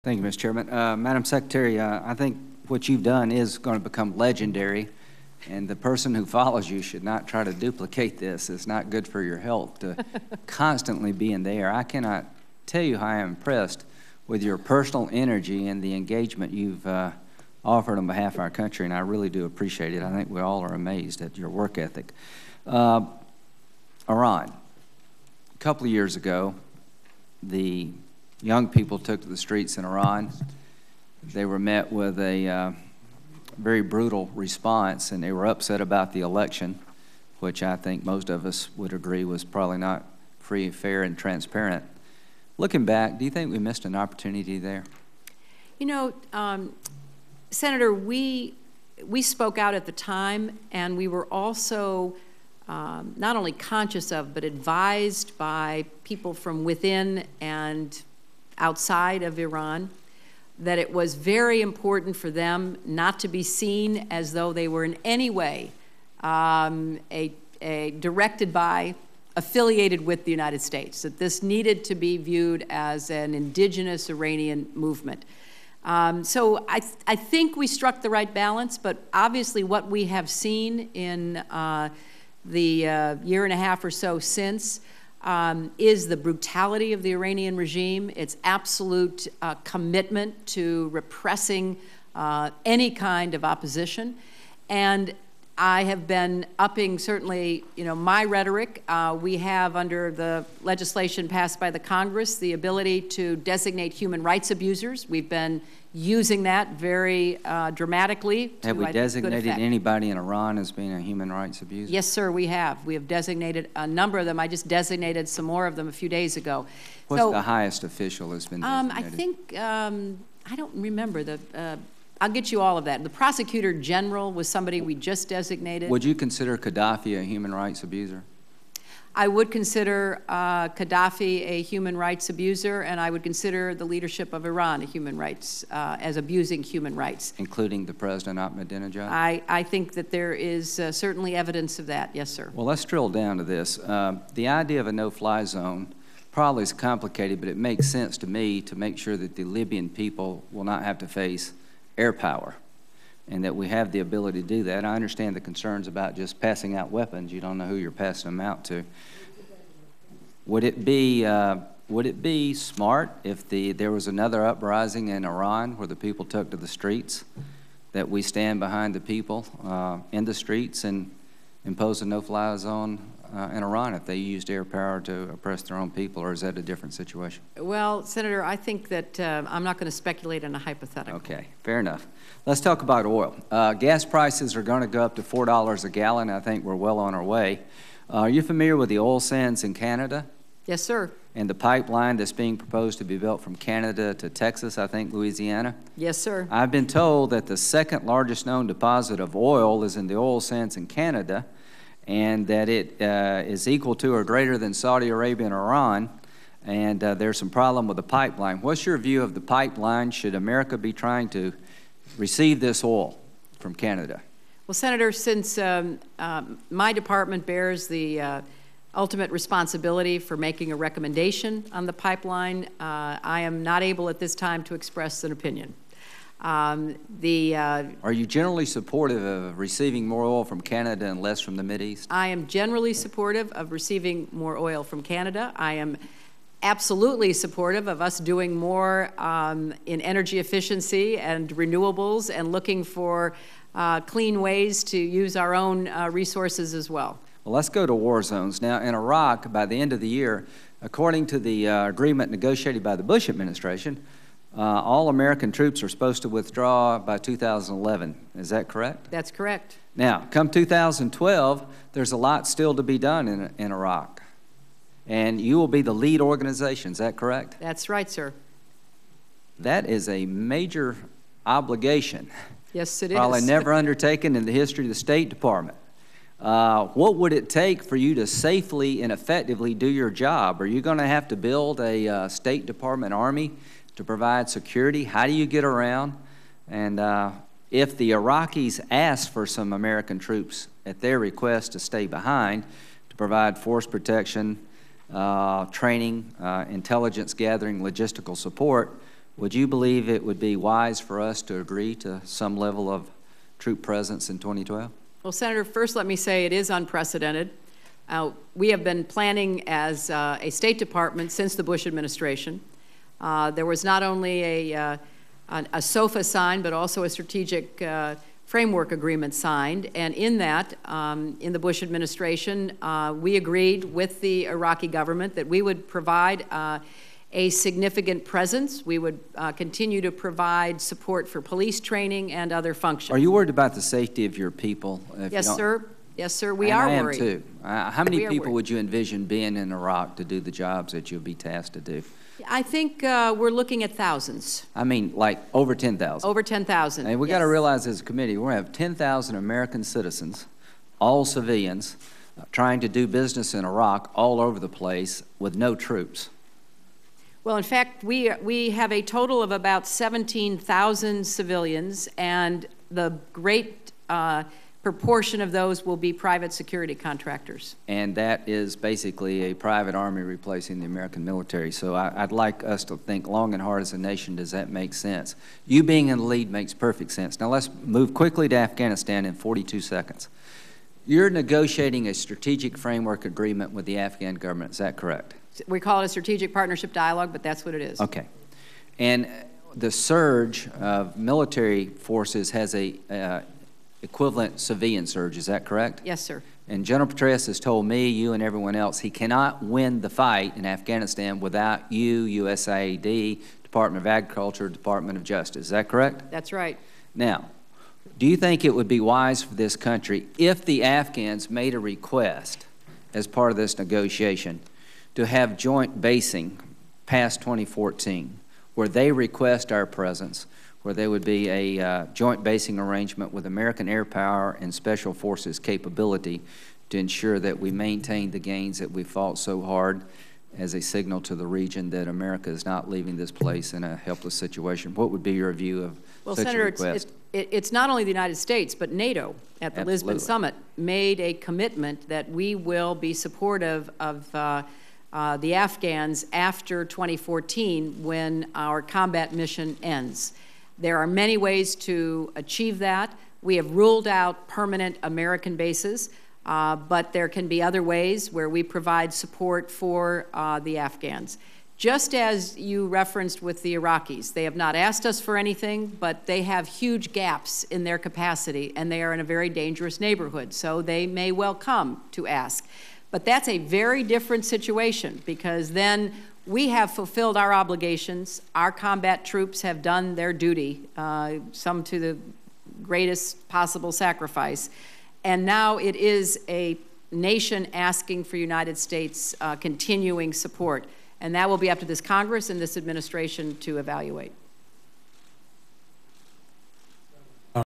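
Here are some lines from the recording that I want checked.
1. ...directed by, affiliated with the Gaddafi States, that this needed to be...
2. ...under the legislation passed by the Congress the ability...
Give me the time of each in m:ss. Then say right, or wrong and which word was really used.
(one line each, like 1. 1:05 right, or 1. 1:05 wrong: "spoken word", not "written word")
1. 1:07 wrong: "United", not "Gaddafi"
2. 1:39 right.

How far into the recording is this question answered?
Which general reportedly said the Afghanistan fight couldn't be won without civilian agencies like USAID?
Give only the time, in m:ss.
6:36.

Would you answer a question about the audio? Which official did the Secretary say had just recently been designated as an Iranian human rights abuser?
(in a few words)
The prosecutor general.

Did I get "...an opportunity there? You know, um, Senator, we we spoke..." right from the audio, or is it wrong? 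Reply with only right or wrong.
right.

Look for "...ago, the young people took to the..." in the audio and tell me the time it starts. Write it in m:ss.
0:26.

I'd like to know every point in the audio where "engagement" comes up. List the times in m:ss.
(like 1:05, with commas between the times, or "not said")
0:15.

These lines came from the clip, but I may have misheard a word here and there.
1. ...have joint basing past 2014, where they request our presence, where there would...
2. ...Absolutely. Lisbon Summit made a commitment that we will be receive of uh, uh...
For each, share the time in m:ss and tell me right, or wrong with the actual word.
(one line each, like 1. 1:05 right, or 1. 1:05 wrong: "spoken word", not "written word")
1. 6:55 right
2. 7:19 wrong: "supportive", not "receive".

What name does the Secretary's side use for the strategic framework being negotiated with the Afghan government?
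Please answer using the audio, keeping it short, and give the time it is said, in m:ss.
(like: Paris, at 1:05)
Strategic partnership dialogue, at 6:26.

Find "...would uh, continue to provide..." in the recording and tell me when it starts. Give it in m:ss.
5:28.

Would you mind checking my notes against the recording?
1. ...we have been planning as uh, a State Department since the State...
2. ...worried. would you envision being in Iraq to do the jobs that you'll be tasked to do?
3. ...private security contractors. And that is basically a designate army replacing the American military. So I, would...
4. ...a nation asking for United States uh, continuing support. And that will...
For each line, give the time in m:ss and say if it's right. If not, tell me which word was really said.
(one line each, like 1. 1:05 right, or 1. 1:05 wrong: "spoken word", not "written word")
1. 5:08 wrong: "Bush", not "State"
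2. 5:38 right
3. 6:06 wrong: "private", not "designate"
4. 8:06 right.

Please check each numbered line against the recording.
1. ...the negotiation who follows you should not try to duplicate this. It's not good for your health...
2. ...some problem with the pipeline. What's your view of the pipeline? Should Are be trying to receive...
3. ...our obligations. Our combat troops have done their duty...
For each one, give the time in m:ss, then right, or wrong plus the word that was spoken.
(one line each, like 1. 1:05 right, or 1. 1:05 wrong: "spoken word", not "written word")
1. 0:05 wrong: "person", not "negotiation"
2. 3:27 wrong: "America", not "Are"
3. 7:57 right.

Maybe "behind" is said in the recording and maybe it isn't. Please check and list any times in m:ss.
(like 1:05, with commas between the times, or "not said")
2:48, 4:52.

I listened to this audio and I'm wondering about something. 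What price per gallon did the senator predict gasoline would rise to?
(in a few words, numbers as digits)
$4.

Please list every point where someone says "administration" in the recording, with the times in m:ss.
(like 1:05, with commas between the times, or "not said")
4:13, 5:11, 5:21, 8:12.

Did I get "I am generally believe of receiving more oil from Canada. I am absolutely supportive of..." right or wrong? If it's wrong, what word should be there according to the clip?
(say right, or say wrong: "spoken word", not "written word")
wrong: "supportive", not "believe".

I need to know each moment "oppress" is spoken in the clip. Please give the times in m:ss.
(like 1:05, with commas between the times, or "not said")
2:55.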